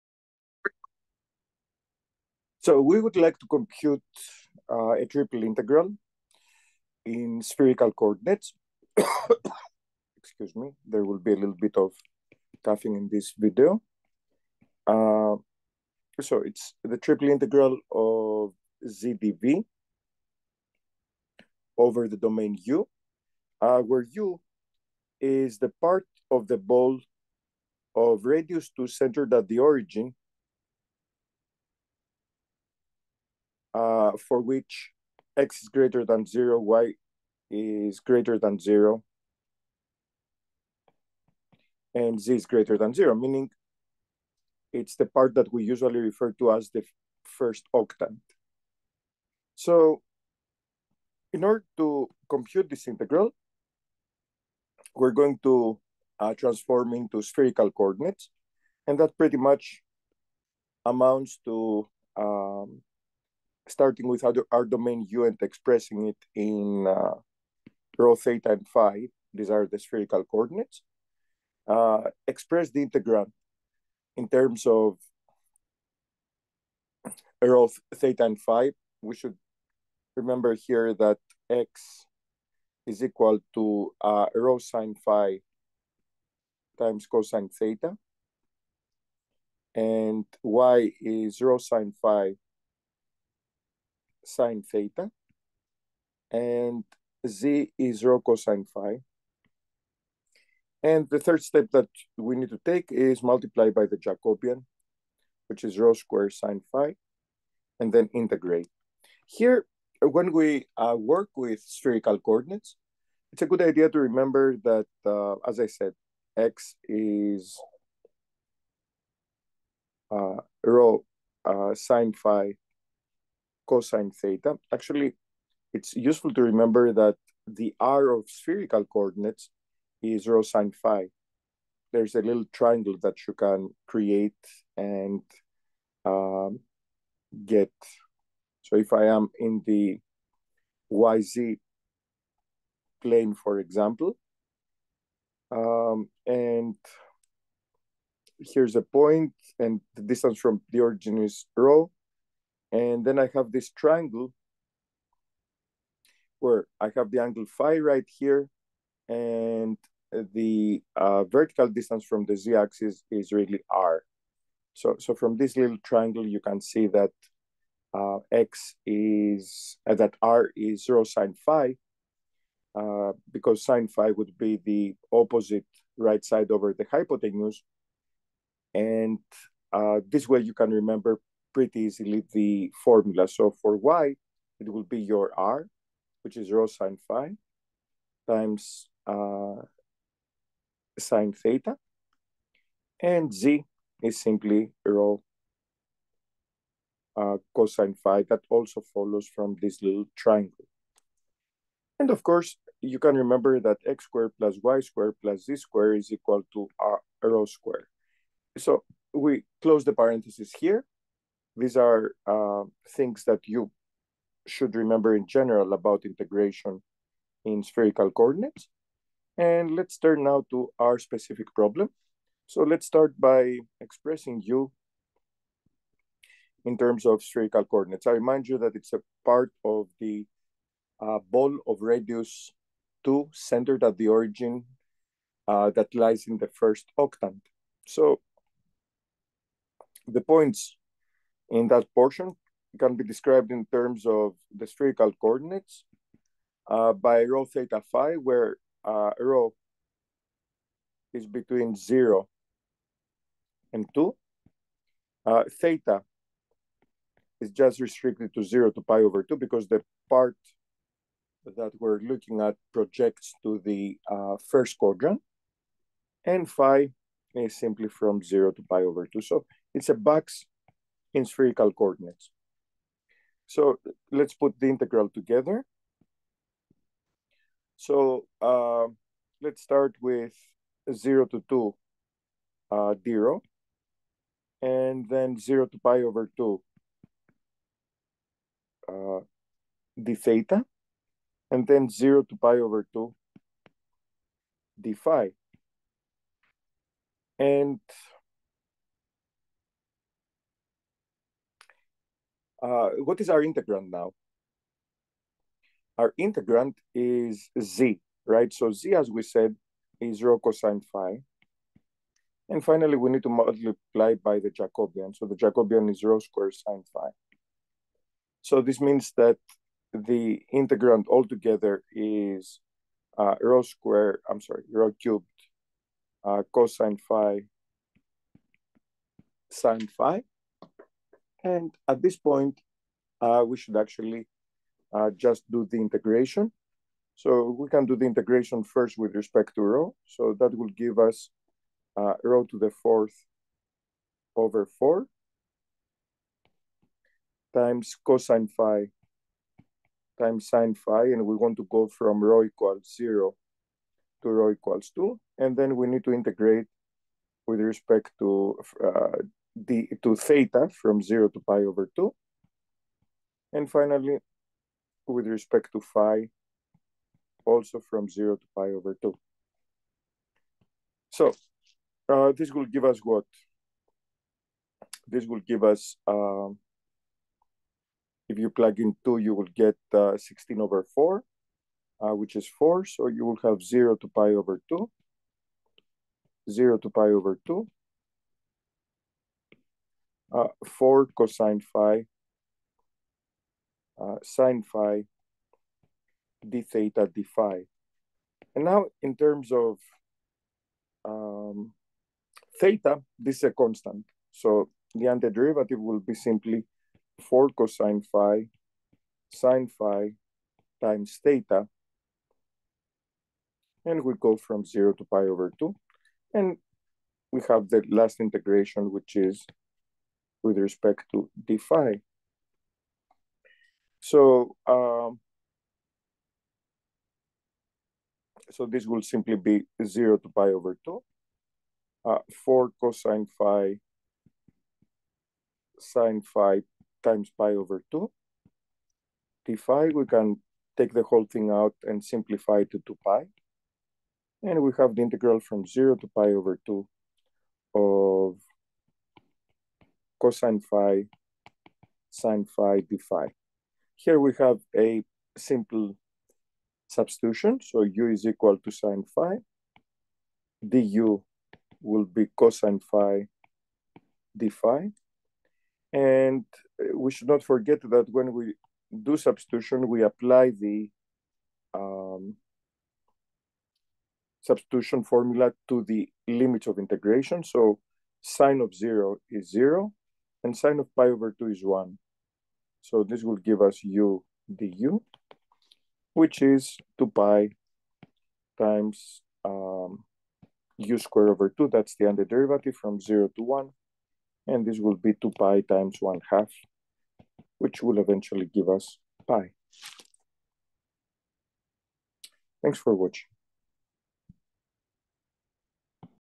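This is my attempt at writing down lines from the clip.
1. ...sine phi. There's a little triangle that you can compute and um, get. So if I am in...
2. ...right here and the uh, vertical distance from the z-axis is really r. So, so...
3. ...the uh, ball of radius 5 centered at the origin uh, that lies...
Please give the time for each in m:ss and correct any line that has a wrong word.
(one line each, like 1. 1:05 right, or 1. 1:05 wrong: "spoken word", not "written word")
1. 2:10 wrong: "create", not "compute"
2. 2:37 right
3. 3:49 wrong: "2", not "5".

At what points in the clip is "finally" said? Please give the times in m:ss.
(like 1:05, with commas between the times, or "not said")
5:12, 6:03.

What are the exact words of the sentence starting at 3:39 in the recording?
And let's turn now to our specific problem.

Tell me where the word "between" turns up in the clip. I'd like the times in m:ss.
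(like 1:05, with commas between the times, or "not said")
4:11.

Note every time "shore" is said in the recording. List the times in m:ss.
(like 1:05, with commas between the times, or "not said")
not said.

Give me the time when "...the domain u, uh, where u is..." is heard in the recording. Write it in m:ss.
0:22.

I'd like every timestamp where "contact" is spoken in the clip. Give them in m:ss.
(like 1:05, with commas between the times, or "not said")
not said.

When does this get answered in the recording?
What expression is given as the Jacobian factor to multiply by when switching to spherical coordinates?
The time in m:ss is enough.
1:45.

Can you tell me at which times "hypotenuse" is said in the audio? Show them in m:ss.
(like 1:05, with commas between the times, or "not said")
2:56.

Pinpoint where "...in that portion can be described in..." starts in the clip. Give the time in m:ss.
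4:01.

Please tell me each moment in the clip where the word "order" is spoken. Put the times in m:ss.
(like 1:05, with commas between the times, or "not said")
0:51.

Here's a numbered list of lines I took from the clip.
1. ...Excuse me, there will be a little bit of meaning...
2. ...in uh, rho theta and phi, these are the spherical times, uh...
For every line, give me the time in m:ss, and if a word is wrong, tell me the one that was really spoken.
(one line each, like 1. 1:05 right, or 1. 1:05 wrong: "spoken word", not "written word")
1. 0:10 wrong: "coughing", not "meaning"
2. 1:06 wrong: "coordinates", not "times".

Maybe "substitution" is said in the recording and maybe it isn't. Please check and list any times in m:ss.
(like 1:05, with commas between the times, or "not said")
7:36, 7:49, 7:54.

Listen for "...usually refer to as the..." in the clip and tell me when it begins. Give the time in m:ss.
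0:45.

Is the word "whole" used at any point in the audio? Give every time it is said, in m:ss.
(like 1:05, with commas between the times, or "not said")
7:21.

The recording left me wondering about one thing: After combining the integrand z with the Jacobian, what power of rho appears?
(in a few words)
rho cubed.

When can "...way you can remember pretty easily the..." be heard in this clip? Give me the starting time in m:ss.
3:00.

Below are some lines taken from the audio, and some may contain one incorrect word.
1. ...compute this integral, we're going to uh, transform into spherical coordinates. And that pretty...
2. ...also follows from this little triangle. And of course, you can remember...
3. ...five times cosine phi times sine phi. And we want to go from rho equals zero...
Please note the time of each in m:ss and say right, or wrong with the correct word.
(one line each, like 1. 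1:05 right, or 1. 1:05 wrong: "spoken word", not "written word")
1. 0:52 right
2. 3:18 right
3. 5:44 wrong: "four", not "five".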